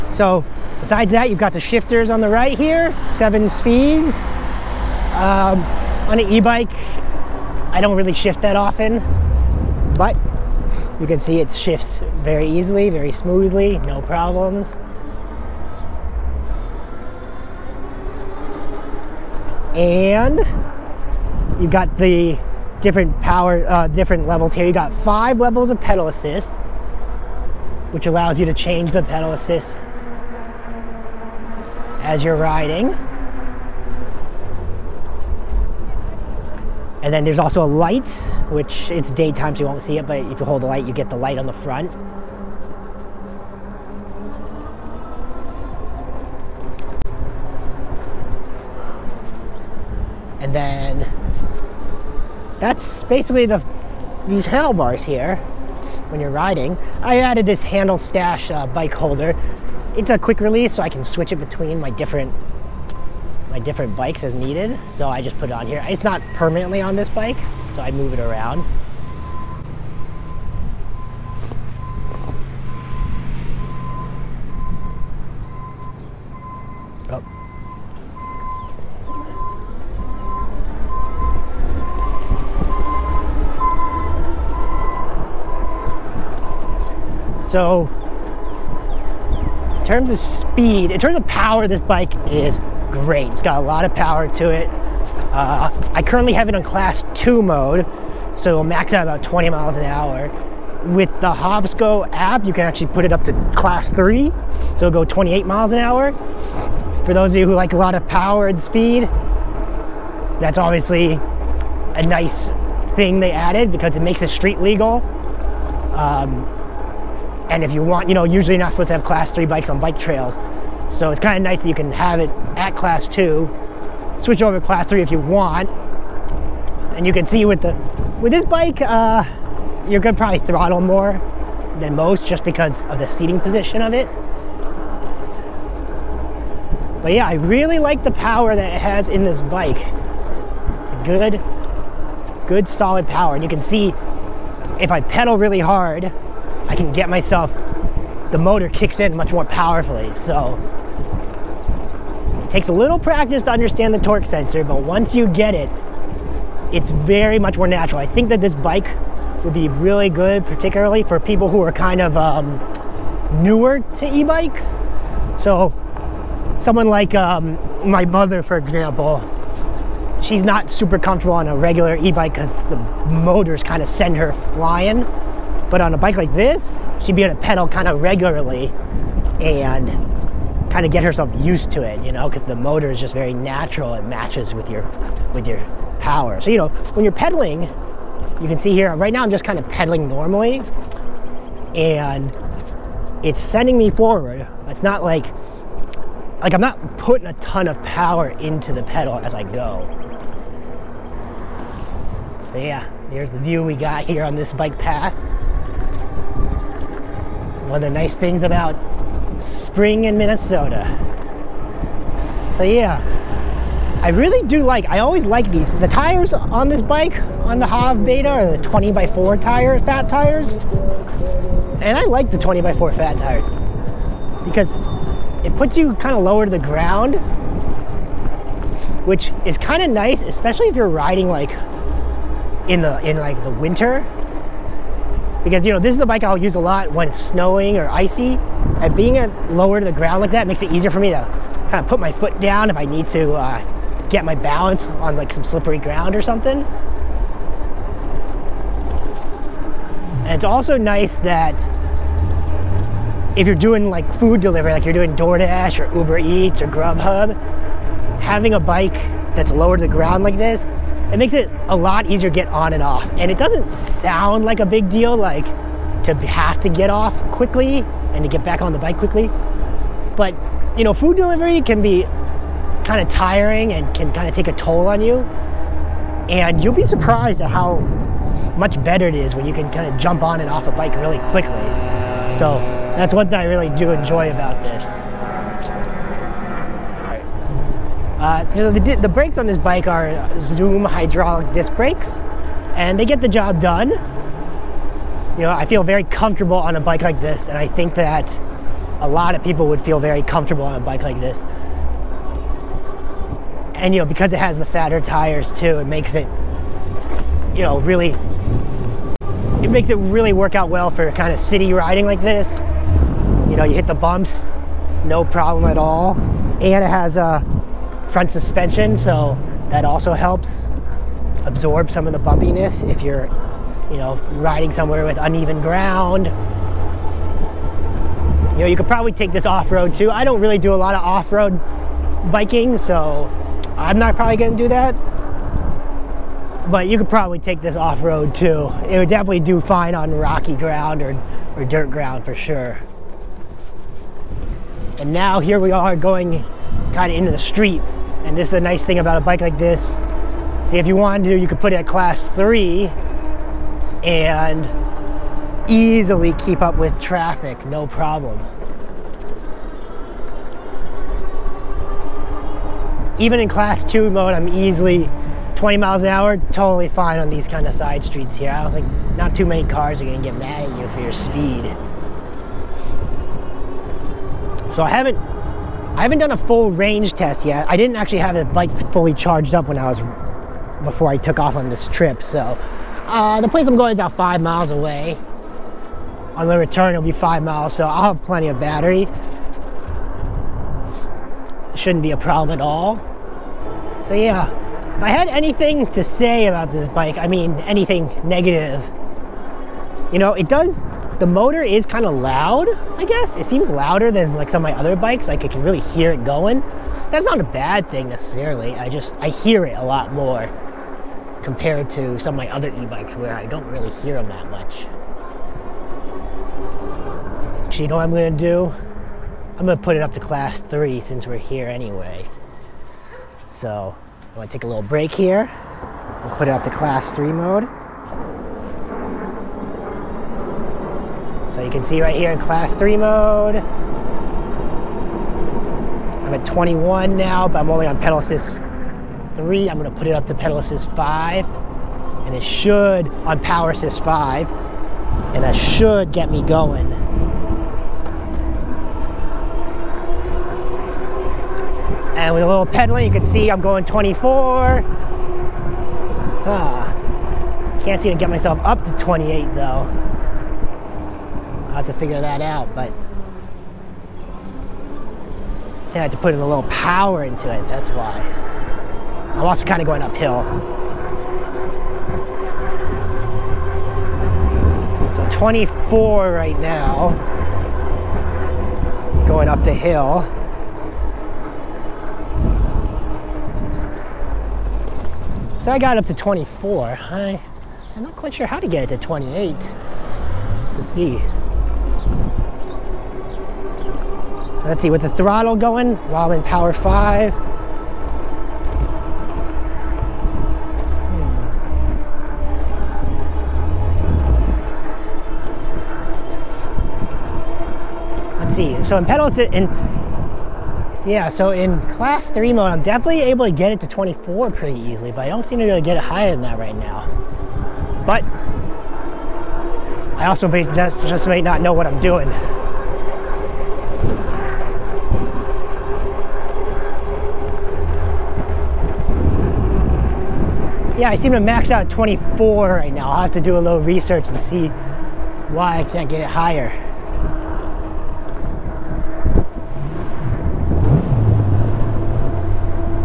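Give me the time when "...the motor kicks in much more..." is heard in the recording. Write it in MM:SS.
02:28.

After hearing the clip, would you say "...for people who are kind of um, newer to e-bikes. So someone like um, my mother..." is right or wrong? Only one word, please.
right.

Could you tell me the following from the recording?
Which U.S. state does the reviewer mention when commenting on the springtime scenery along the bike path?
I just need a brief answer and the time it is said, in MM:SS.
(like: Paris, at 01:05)
Minnesota, at 03:30.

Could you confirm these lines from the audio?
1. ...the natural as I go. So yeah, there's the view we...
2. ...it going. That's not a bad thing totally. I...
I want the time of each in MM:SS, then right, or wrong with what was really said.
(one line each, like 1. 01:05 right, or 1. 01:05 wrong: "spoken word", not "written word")
1. 03:18 wrong: "pedal", not "natural"
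2. 06:46 wrong: "necessarily", not "totally".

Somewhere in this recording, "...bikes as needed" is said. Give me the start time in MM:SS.
01:03.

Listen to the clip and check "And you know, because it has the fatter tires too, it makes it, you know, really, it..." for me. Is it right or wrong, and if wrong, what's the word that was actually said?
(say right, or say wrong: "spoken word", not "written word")
right.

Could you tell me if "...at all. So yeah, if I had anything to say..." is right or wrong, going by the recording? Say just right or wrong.
right.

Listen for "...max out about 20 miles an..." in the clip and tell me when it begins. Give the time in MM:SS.
01:38.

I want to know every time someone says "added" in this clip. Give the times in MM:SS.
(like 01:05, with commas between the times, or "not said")
00:57, 01:53.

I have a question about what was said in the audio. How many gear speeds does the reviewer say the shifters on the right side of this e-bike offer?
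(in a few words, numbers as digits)
7.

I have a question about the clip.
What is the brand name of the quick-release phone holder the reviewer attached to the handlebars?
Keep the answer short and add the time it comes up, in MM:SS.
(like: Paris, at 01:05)
Handlestash, at 00:57.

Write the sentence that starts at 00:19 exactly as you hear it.
And you've got the different power, uh, different levels here.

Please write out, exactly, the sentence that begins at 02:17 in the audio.
But yeah, I really like the power that it has in this bike.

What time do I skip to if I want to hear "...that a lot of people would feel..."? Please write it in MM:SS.
04:57.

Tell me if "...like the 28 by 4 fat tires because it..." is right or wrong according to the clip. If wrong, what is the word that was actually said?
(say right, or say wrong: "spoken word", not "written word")
wrong: "20", not "28".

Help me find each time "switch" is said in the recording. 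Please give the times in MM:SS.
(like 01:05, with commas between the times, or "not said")
01:01, 02:04.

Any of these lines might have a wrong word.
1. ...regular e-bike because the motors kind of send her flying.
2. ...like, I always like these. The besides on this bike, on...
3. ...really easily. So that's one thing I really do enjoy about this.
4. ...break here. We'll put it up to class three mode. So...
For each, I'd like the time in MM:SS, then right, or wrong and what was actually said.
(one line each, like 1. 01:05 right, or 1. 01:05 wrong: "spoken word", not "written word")
1. 02:51 right
2. 03:34 wrong: "tires", not "besides"
3. 04:40 wrong: "quickly", not "easily"
4. 07:04 right.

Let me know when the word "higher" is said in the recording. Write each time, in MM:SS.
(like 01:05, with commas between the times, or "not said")
08:56.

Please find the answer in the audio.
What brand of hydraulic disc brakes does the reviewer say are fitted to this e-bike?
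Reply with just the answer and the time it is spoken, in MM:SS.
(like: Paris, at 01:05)
Zoom, at 04:50.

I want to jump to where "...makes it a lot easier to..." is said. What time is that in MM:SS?
04:21.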